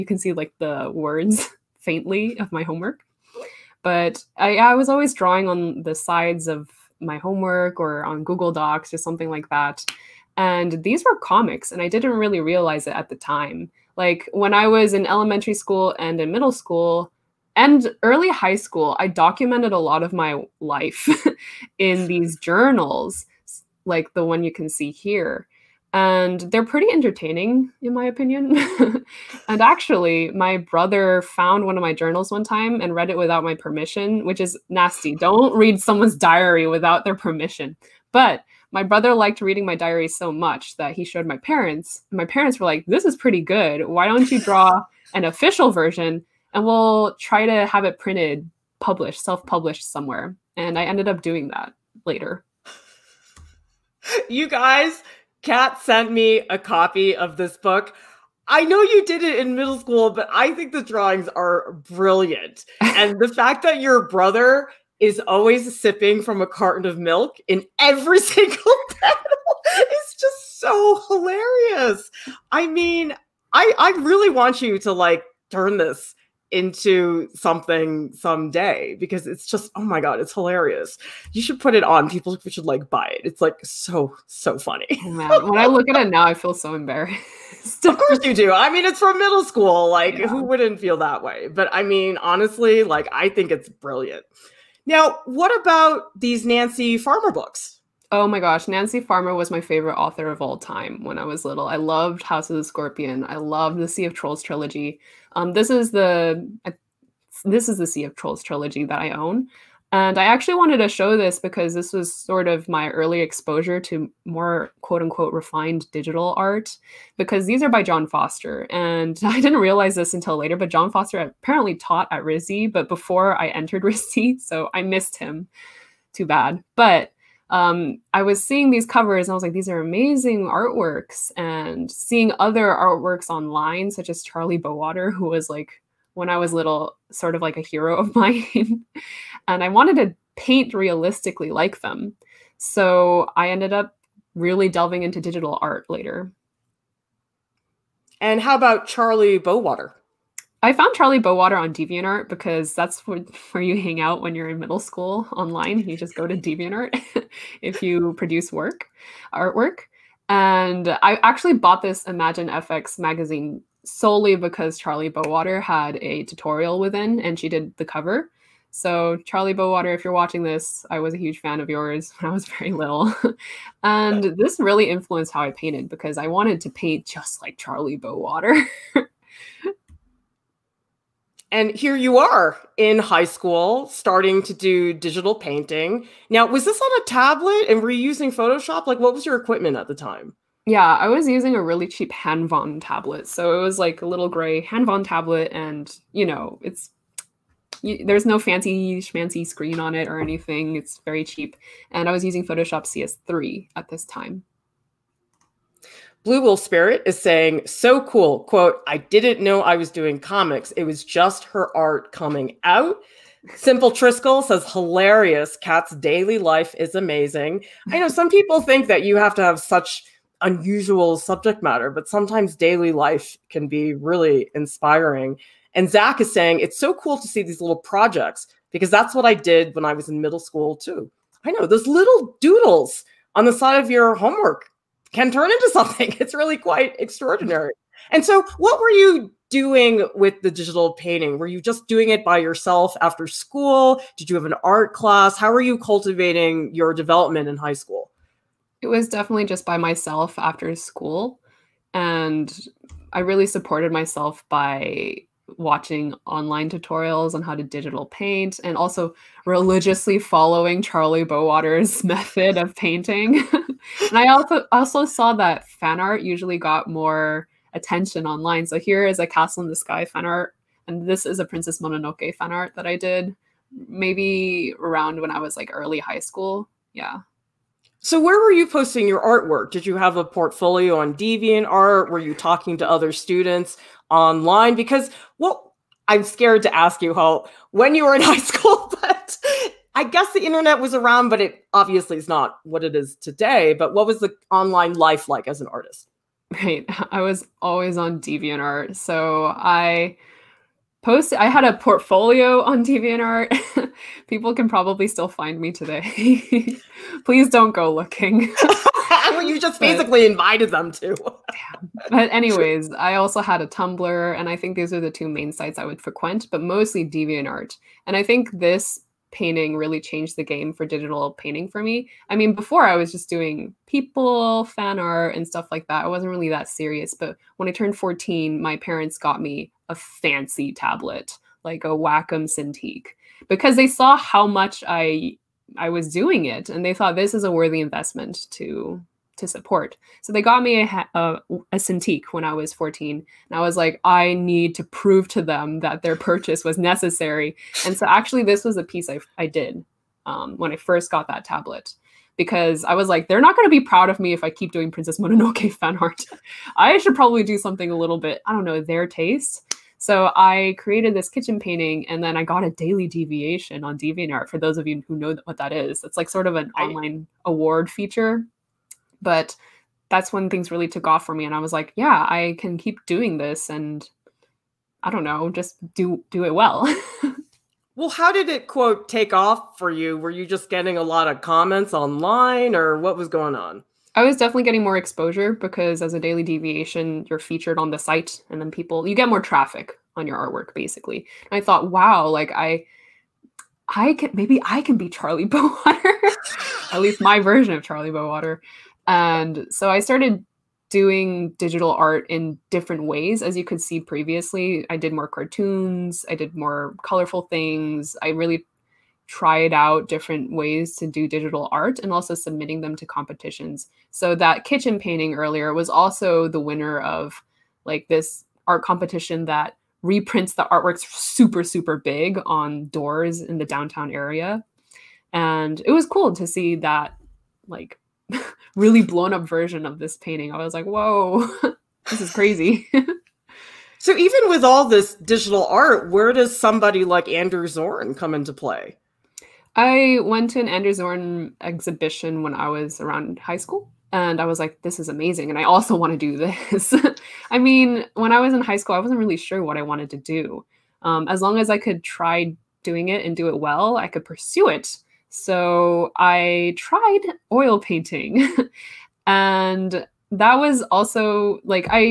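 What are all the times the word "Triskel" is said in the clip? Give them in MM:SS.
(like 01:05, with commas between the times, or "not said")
03:33.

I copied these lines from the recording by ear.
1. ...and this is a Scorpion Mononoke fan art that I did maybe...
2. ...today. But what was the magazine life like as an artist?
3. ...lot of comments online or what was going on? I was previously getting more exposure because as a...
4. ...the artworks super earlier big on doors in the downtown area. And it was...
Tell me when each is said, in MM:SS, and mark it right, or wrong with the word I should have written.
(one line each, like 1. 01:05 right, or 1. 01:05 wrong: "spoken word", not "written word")
1. 04:30 wrong: "Princess", not "Scorpion"
2. 04:53 wrong: "online", not "magazine"
3. 06:21 wrong: "definitely", not "previously"
4. 07:00 wrong: "super", not "earlier".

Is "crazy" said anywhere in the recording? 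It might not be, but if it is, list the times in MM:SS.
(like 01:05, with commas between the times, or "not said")
07:12.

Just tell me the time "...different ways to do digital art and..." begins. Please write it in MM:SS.
06:50.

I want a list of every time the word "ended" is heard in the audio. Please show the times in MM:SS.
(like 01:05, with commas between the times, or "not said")
00:50, 02:23.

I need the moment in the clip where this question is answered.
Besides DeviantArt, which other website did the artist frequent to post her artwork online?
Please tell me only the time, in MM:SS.
05:13.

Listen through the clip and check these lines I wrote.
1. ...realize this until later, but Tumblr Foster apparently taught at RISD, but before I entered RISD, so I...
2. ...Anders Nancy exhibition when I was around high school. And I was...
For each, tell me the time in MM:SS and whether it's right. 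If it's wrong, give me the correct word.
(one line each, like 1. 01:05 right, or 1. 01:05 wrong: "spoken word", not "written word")
1. 01:59 wrong: "Jon", not "Tumblr"
2. 07:20 wrong: "Zorn", not "Nancy".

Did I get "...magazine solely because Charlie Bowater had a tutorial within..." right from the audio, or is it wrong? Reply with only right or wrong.
right.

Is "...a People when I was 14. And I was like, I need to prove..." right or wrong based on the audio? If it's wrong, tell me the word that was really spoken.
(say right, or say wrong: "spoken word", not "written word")
wrong: "Cintiq", not "People".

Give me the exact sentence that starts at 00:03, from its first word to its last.
But I I was always drawing on the sides of my homework or on Google Docs or something like that.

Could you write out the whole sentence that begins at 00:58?
I know you did it in middle school, but I think the drawings are brilliant.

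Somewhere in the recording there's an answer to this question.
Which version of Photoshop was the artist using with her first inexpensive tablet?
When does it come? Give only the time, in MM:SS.
03:22.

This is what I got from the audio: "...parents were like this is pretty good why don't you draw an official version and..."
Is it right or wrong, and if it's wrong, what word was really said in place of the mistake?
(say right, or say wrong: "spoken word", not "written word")
right.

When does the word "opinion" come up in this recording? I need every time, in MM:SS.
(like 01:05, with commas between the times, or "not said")
00:28.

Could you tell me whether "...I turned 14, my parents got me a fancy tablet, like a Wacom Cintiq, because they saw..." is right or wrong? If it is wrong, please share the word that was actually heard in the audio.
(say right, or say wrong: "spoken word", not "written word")
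right.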